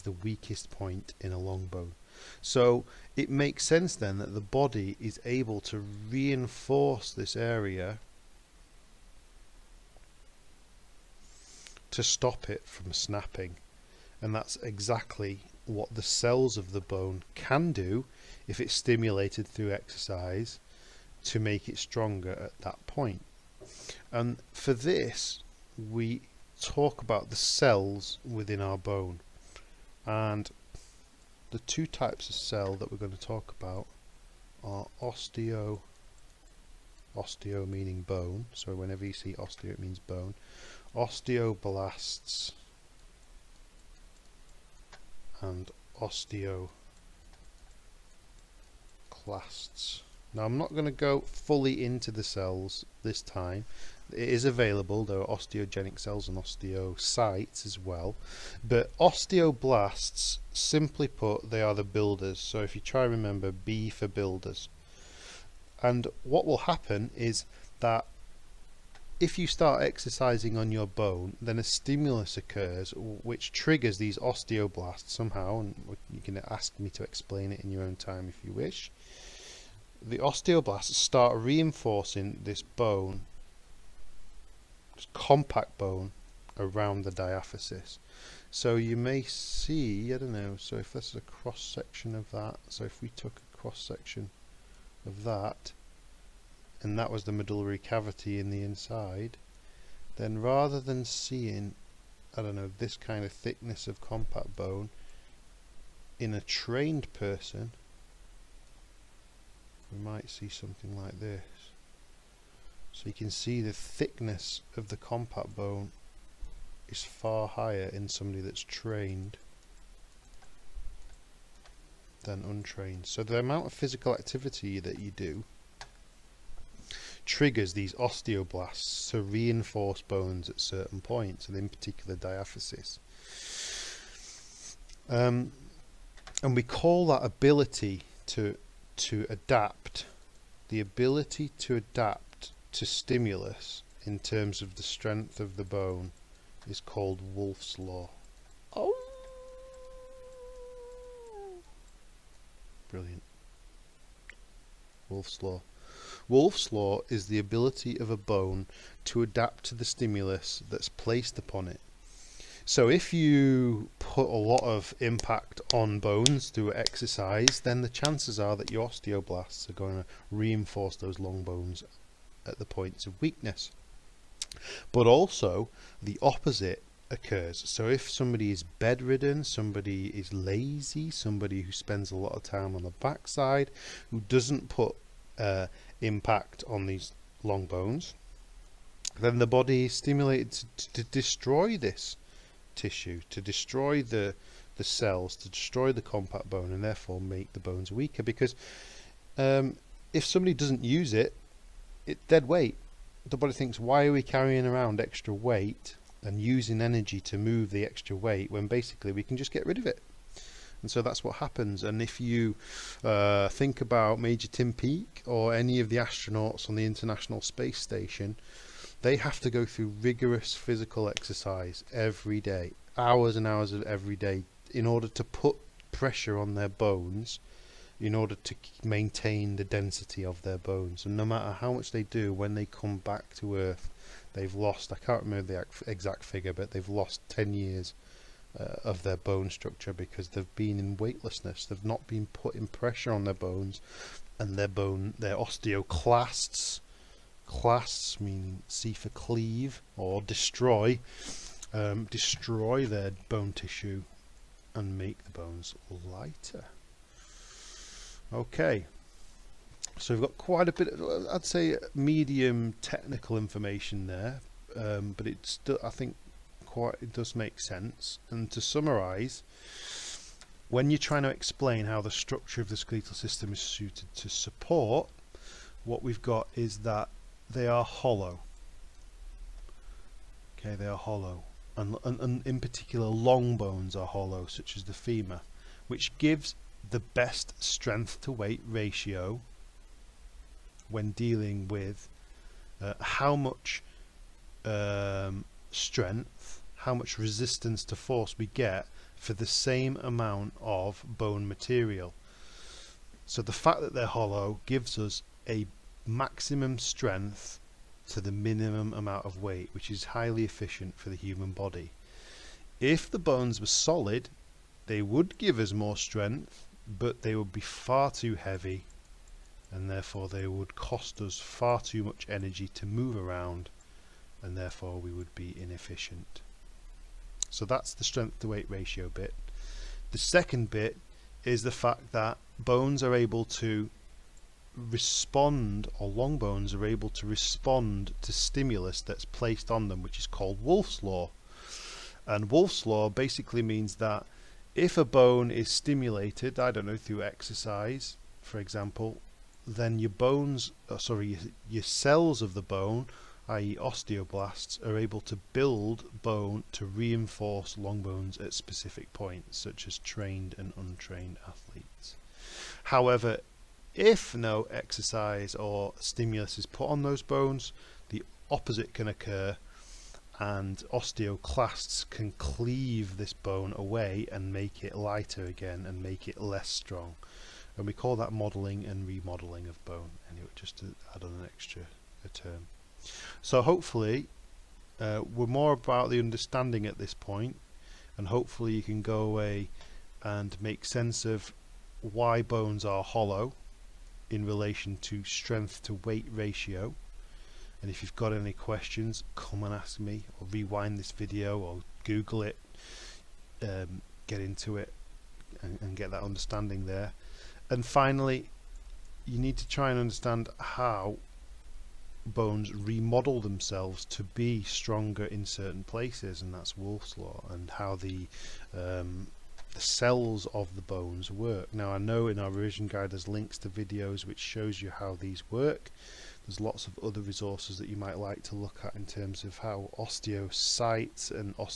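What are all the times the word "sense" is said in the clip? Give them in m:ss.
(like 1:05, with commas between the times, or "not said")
0:03, 4:27, 6:30.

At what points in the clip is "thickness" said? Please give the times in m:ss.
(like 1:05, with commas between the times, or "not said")
1:43, 1:53.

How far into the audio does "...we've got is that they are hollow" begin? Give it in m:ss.
4:36.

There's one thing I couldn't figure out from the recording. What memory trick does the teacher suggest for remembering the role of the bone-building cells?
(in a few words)
B for builders.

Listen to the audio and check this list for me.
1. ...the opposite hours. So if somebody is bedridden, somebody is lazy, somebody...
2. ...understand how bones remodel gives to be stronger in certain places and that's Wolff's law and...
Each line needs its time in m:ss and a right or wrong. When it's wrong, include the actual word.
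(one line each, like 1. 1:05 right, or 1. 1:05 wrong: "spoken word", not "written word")
1. 2:56 wrong: "occurs", not "hours"
2. 6:49 wrong: "themselves", not "gives".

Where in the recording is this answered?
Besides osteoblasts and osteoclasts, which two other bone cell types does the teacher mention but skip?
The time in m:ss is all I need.
0:55.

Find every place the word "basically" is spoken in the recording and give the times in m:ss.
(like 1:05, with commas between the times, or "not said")
3:28, 5:43.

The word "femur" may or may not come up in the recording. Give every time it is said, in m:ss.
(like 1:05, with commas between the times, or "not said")
4:44.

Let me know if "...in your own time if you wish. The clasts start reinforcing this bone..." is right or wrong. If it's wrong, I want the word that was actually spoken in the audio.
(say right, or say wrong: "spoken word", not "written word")
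wrong: "osteoblasts", not "clasts".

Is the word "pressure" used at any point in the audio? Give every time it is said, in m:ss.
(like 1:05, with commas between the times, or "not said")
3:45, 4:02.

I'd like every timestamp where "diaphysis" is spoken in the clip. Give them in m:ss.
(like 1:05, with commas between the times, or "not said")
1:27, 2:12.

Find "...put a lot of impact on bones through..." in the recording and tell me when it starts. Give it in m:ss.
2:43.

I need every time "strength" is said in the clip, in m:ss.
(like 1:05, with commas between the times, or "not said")
2:24, 4:47, 4:55, 5:06, 5:15, 5:28, 6:35.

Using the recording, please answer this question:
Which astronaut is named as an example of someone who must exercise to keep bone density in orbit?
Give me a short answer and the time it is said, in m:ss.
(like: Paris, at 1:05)
Tim Peake, at 3:34.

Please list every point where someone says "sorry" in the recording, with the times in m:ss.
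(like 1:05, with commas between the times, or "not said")
5:50.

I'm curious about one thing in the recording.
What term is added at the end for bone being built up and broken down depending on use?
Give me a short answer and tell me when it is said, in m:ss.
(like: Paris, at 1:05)
Modelling and remodelling, at 6:18.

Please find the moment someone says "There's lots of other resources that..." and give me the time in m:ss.
7:06.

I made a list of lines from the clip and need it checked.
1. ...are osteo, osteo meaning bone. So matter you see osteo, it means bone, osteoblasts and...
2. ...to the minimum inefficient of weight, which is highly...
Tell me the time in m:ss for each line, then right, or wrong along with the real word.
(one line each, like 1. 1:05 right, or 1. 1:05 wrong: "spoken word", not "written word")
1. 0:34 wrong: "whenever", not "matter"
2. 5:08 wrong: "amount", not "inefficient".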